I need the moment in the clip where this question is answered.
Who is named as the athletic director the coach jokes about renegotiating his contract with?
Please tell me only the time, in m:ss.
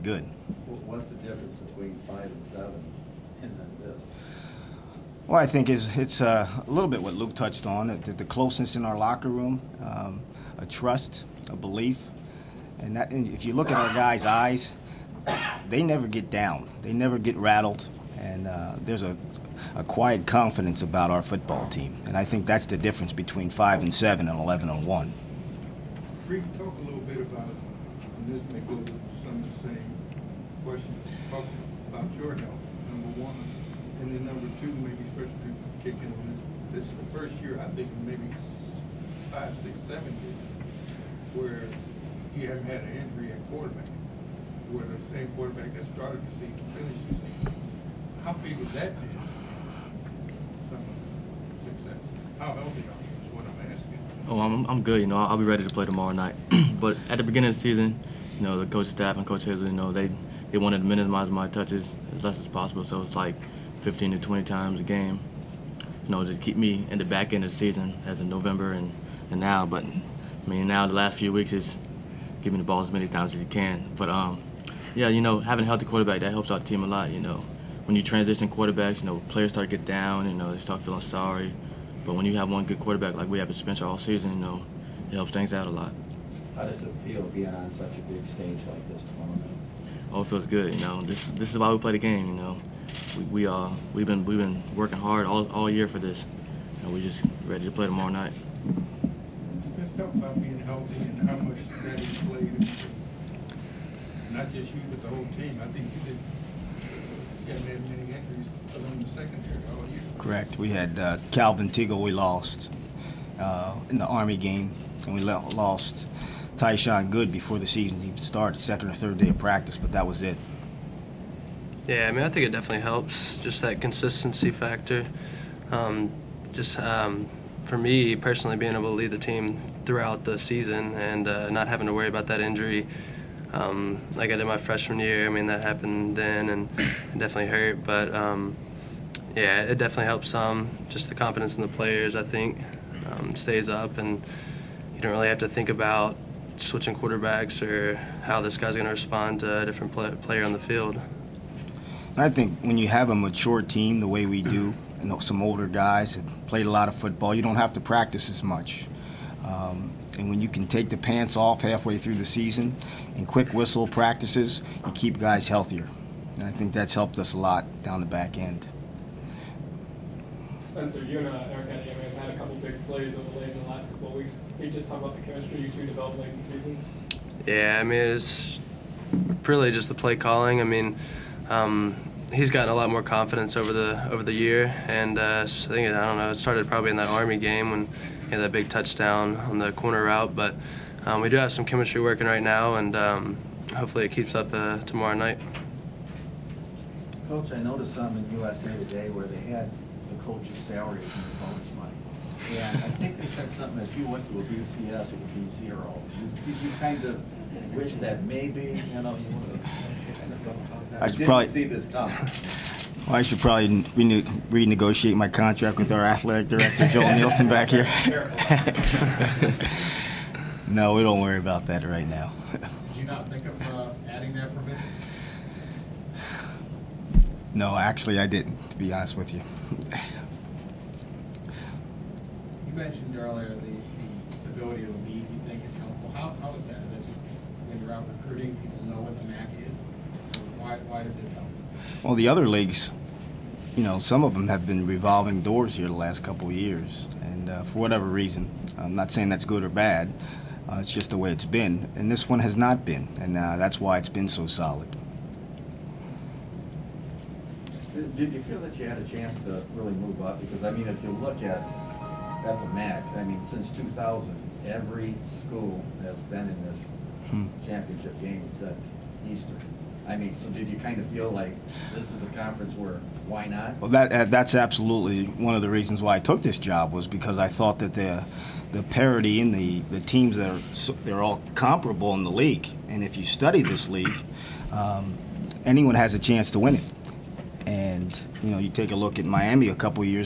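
3:36.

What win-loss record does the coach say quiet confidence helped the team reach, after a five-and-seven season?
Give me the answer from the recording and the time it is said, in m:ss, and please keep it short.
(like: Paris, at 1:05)
11 and 1, at 0:24.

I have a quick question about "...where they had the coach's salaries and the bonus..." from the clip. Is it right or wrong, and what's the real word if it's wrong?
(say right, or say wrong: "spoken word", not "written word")
right.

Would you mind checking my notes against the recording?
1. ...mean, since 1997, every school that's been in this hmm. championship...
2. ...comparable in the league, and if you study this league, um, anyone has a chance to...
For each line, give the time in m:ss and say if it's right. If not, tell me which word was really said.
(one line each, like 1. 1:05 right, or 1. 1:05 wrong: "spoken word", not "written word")
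1. 4:23 wrong: "2000", not "1997"
2. 4:41 right.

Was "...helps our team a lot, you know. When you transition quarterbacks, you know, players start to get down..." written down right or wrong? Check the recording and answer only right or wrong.
right.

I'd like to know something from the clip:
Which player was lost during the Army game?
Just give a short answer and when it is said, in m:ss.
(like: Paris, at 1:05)
Calvin Teagle, at 1:51.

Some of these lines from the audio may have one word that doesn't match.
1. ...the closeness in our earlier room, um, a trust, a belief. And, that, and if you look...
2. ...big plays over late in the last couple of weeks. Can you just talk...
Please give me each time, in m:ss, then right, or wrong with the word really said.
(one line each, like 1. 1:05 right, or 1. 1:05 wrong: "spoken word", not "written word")
1. 0:08 wrong: "locker", not "earlier"
2. 2:52 right.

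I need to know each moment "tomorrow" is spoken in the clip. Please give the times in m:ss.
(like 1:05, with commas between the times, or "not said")
0:55, 1:37, 3:14.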